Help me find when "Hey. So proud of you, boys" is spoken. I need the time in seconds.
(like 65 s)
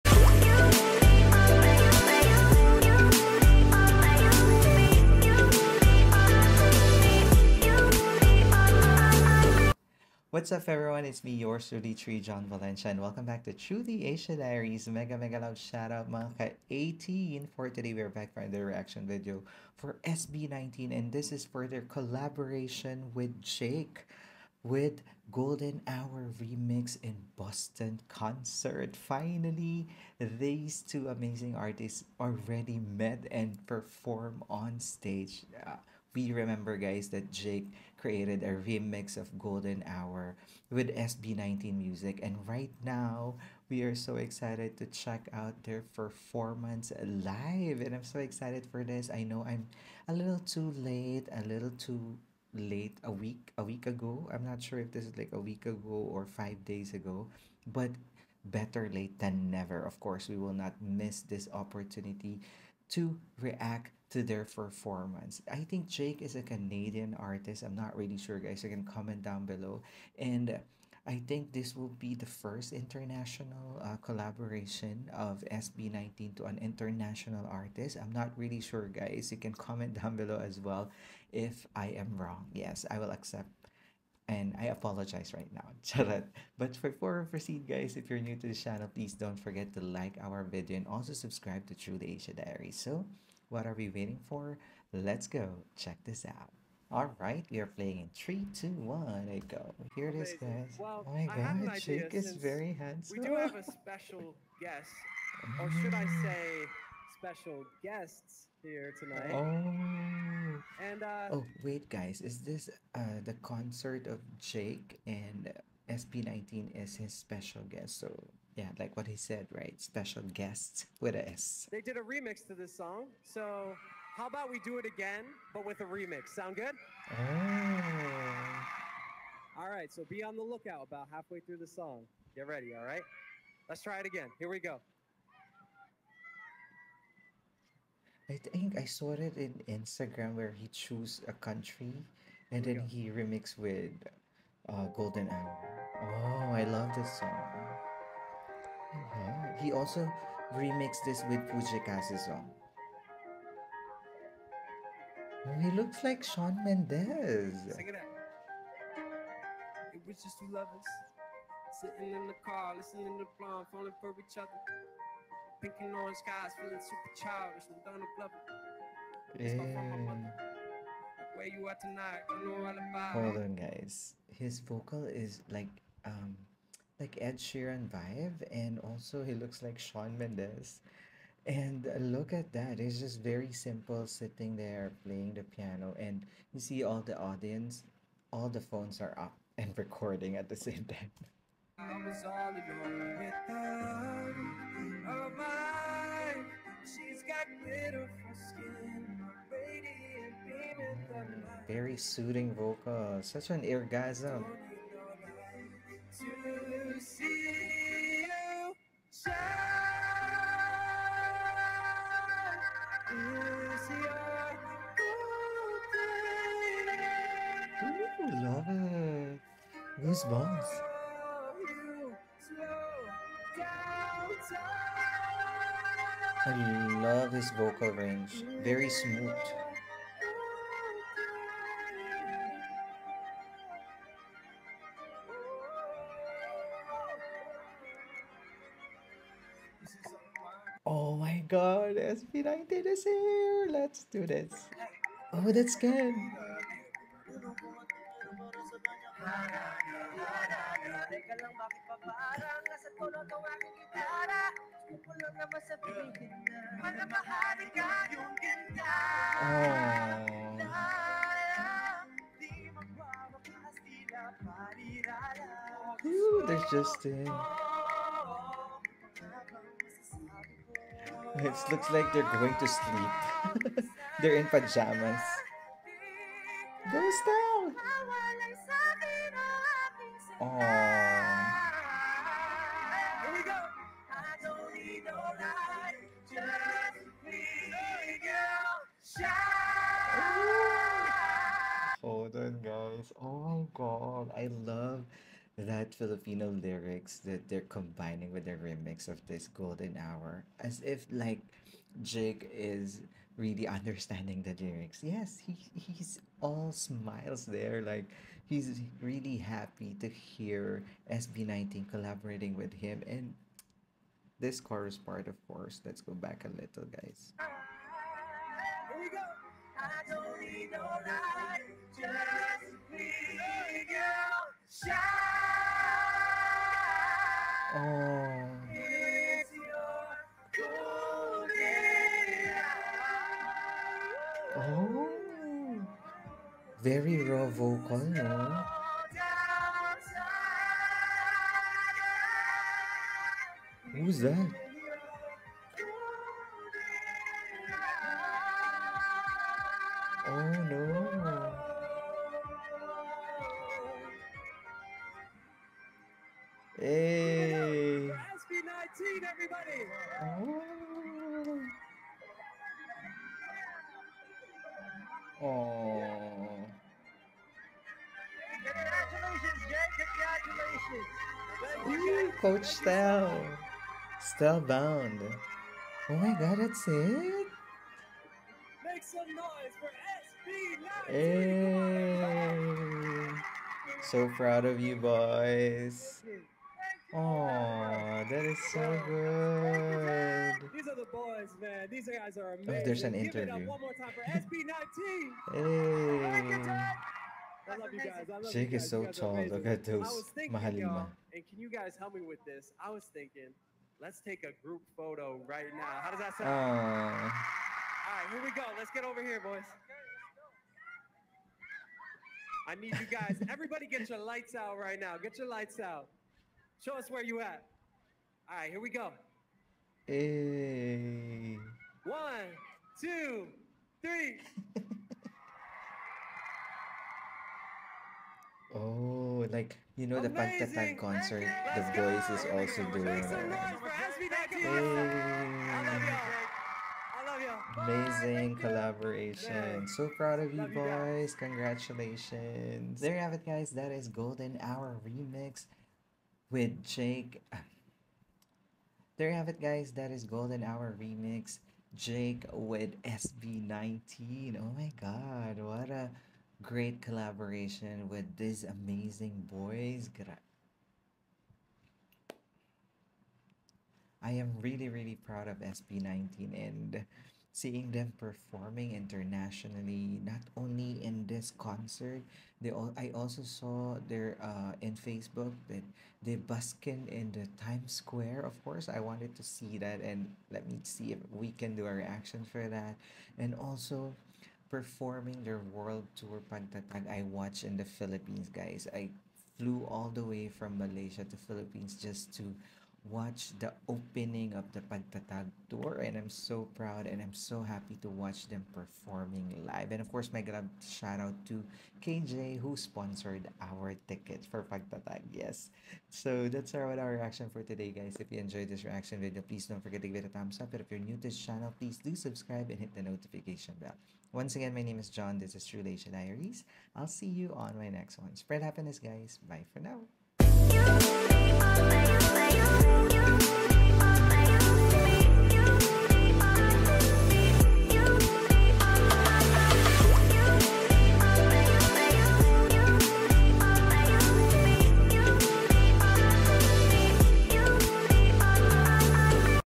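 383 s.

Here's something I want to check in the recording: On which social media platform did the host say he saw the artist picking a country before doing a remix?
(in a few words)
Instagram.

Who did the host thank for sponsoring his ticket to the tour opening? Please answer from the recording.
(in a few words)
KJ.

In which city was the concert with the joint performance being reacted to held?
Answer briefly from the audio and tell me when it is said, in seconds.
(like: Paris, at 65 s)
Boston, at 27 s.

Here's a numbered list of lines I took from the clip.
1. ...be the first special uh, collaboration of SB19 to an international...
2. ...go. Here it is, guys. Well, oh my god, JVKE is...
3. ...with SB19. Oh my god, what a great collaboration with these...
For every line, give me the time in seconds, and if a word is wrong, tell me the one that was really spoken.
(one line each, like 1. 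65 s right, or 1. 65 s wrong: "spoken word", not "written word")
1. 71 s wrong: "international", not "special"
2. 99 s right
3. 452 s right.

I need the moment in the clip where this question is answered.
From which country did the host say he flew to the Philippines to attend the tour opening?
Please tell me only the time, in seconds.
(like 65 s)
490 s.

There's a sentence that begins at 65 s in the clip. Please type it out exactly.
I think JVKE is a Canadian artist.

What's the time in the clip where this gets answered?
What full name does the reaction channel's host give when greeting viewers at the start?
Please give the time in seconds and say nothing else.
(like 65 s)
12 s.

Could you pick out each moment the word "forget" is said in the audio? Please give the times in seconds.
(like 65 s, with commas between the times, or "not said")
89 s, 509 s.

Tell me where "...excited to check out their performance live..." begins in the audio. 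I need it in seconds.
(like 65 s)
44 s.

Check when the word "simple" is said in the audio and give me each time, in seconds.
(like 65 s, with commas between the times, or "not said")
183 s.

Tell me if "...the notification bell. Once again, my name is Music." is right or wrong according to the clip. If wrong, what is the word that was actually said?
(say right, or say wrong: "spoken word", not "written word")
wrong: "John", not "Music".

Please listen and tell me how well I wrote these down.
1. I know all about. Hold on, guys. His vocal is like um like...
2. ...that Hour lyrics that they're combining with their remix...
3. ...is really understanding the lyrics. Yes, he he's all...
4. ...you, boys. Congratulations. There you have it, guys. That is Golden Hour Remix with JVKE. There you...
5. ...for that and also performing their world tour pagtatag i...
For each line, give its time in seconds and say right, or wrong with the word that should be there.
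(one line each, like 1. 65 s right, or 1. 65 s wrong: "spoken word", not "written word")
1. 172 s right
2. 295 s wrong: "Filipino", not "Hour"
3. 302 s right
4. 440 s right
5. 482 s right.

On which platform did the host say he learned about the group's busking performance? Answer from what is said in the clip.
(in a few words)
Facebook.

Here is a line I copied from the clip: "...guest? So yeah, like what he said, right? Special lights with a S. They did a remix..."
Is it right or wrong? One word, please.
wrong.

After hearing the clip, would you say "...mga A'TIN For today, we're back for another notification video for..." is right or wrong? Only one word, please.
wrong.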